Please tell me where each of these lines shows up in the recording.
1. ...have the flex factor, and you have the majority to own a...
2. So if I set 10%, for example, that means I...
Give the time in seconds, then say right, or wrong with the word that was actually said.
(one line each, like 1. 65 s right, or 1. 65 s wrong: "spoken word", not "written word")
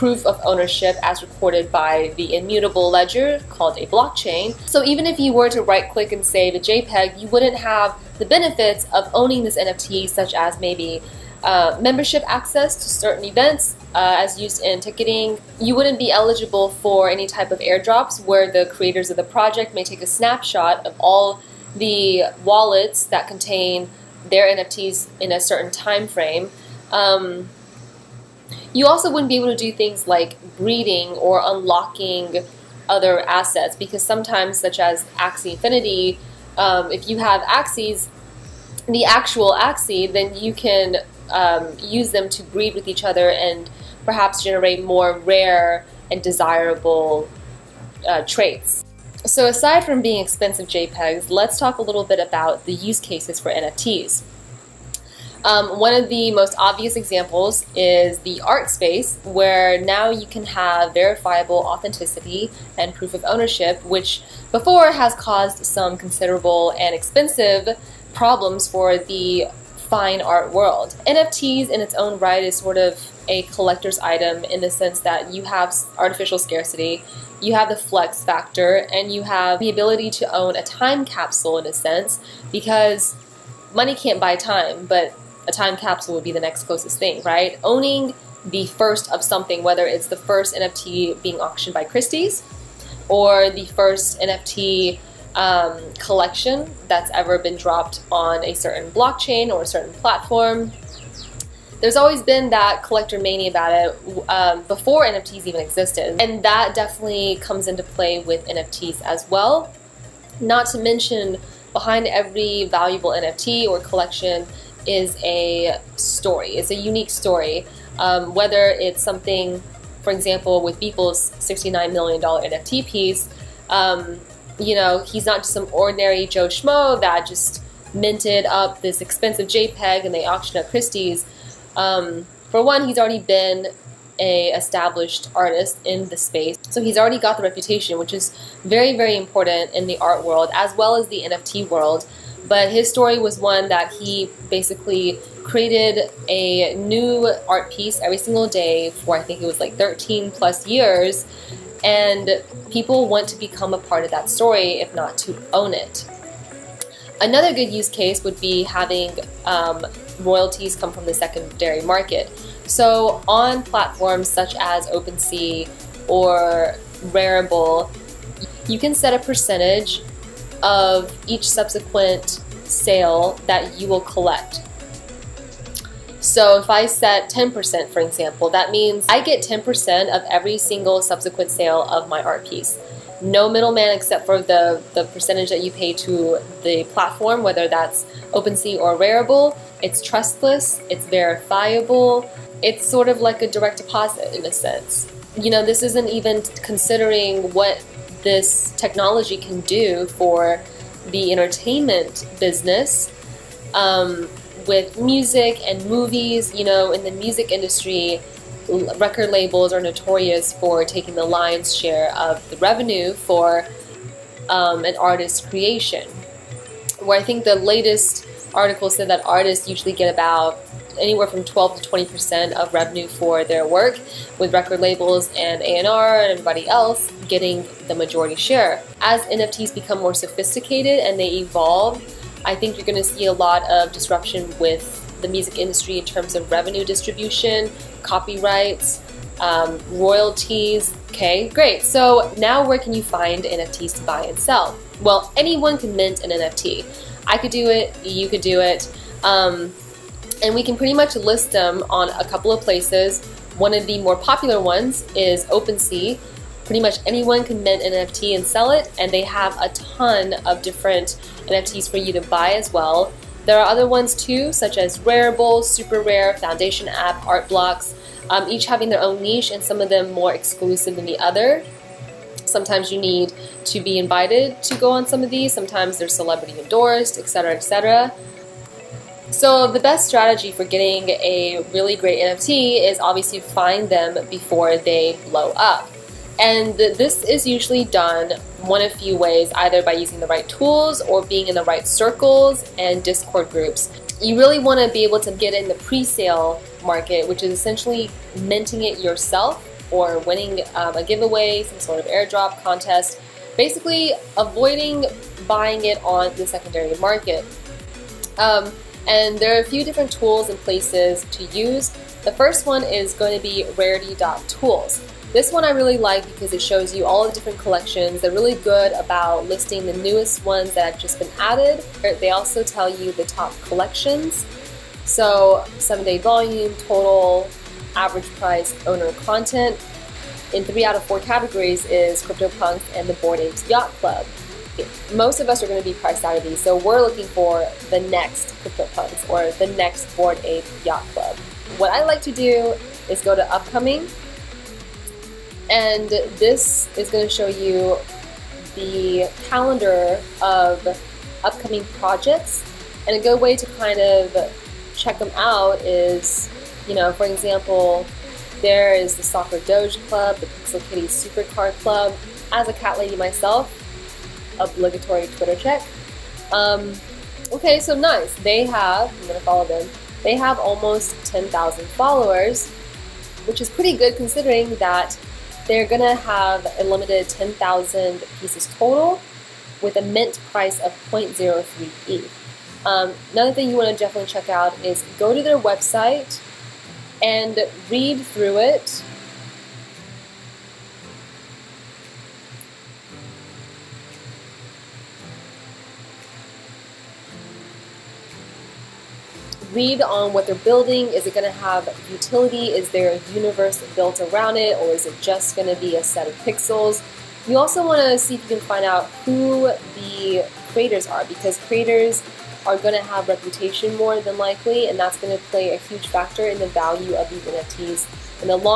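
1. 77 s wrong: "ability", not "majority"
2. 176 s right.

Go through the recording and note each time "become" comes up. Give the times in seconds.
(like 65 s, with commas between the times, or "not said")
153 s, 229 s.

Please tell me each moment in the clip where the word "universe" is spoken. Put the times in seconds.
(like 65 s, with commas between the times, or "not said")
403 s.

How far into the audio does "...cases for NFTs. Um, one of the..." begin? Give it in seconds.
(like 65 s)
52 s.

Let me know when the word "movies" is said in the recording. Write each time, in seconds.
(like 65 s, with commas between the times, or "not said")
205 s.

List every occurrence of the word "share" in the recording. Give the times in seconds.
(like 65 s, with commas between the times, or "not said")
211 s, 228 s.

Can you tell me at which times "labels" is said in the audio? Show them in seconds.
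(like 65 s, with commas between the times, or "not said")
209 s, 224 s.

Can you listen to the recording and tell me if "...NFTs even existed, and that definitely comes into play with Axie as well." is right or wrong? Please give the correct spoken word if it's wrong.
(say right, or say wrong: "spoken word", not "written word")
wrong: "NFTs", not "Axie".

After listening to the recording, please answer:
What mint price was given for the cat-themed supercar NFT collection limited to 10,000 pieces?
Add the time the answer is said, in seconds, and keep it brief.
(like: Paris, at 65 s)
0.03 ETH, at 381 s.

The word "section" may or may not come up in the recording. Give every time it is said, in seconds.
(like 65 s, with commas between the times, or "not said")
not said.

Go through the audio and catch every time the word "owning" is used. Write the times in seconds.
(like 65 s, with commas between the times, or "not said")
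9 s, 87 s.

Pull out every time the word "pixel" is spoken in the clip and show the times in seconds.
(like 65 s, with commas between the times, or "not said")
360 s, 406 s.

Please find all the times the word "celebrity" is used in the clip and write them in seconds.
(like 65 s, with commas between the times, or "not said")
276 s.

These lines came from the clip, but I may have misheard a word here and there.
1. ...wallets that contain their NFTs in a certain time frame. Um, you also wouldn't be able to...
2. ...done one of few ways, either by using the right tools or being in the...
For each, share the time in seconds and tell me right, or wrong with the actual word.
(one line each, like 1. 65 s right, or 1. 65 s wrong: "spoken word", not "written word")
1. 22 s right
2. 287 s right.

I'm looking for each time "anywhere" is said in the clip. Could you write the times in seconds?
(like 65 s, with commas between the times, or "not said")
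220 s.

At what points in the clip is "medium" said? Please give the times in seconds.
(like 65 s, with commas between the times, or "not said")
not said.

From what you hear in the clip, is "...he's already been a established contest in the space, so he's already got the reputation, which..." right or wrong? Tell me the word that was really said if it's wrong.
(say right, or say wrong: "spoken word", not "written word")
wrong: "artist", not "contest".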